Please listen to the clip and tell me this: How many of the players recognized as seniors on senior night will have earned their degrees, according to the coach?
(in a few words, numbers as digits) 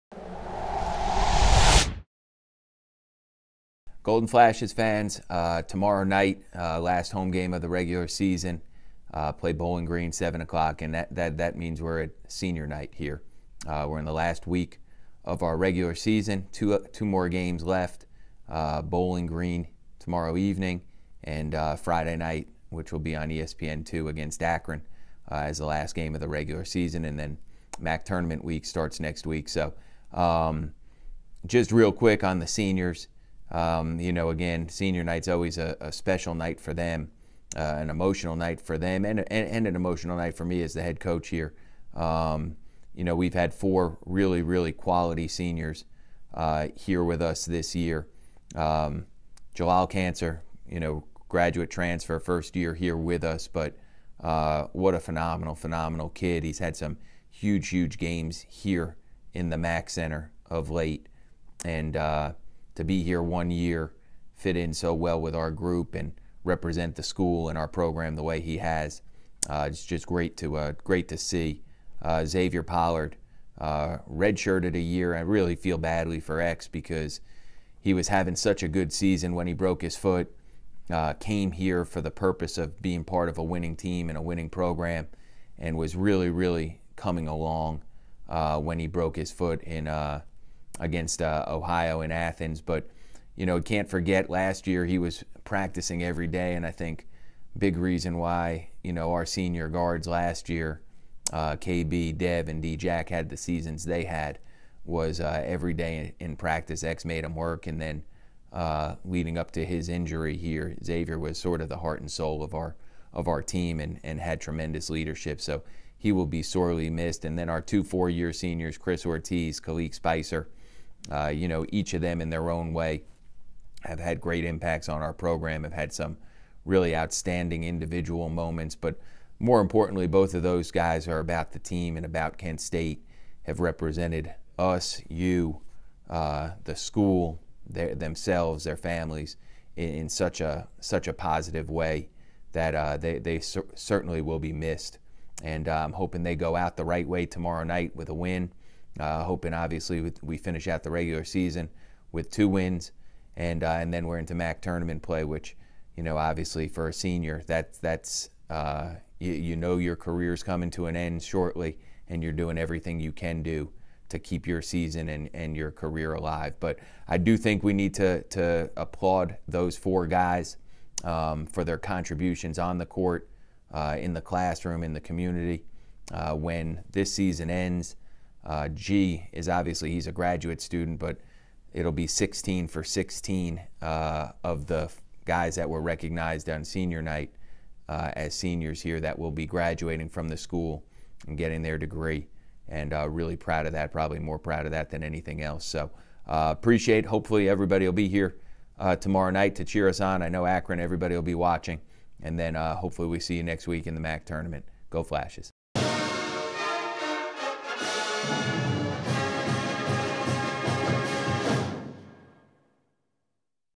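16 for 16.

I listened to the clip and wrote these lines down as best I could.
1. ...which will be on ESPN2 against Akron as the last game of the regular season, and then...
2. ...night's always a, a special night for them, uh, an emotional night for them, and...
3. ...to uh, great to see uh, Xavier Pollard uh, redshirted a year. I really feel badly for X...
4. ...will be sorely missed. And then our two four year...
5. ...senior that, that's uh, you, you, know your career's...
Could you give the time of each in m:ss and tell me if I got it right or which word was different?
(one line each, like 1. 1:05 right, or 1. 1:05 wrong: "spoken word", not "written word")
1. 0:22 right
2. 0:35 right
3. 1:10 right
4. 1:56 right
5. 2:36 right.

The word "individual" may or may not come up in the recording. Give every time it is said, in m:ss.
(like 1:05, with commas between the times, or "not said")
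2:07.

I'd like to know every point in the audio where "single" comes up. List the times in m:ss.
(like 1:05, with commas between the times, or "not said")
not said.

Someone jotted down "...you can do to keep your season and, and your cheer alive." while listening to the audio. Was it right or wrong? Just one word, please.
wrong.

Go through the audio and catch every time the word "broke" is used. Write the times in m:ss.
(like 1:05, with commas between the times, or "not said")
1:19, 1:28.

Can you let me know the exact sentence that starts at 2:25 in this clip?
And uh, I'm hoping they go out the right way tomorrow night with a win.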